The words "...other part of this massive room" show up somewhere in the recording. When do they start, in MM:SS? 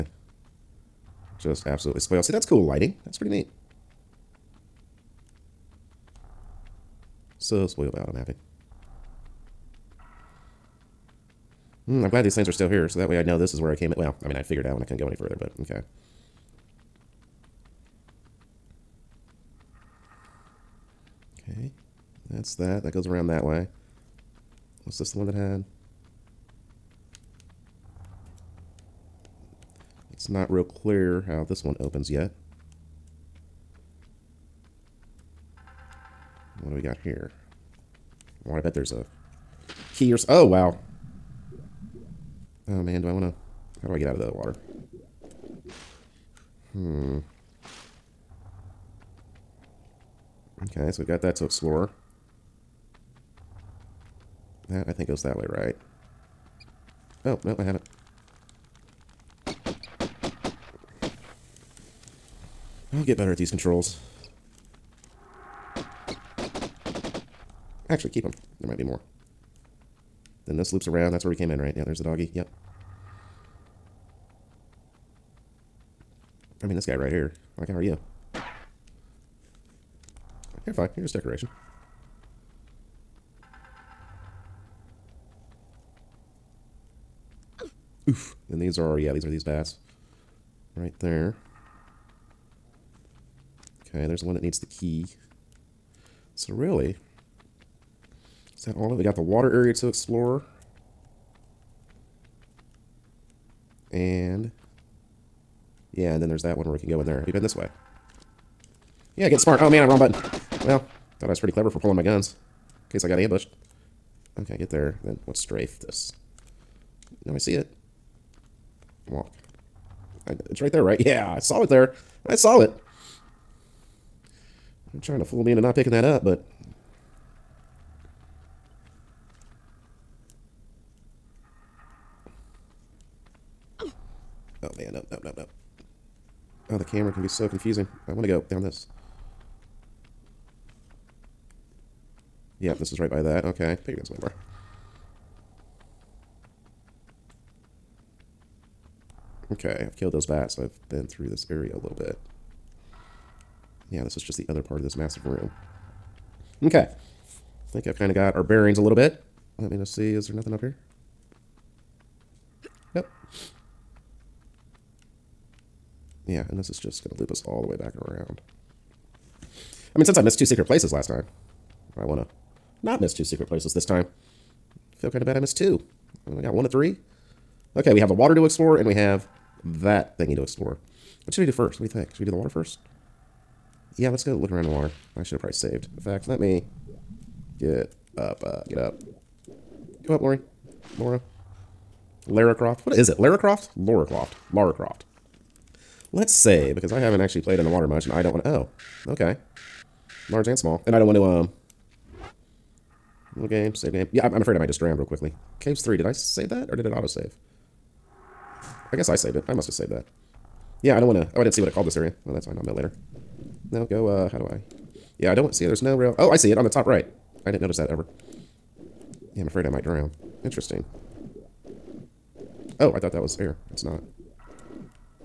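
02:34.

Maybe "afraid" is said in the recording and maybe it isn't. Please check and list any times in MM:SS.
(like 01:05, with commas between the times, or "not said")
03:24, 03:39.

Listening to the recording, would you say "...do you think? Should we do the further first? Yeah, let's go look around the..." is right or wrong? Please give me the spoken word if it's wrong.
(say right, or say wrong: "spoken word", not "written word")
wrong: "water", not "further".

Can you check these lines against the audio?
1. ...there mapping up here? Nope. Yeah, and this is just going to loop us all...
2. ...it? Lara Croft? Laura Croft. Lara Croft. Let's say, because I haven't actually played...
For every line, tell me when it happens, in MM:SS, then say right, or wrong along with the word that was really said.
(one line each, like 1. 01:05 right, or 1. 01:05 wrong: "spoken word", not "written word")
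1. 02:40 wrong: "nothing", not "mapping"
2. 03:13 right.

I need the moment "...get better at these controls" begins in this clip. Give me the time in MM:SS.
01:03.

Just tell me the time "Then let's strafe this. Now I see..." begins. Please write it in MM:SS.
01:55.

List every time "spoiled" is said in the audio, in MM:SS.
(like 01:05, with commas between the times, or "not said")
00:01, 00:07.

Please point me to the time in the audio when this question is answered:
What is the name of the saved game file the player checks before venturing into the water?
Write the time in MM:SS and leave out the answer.
03:25.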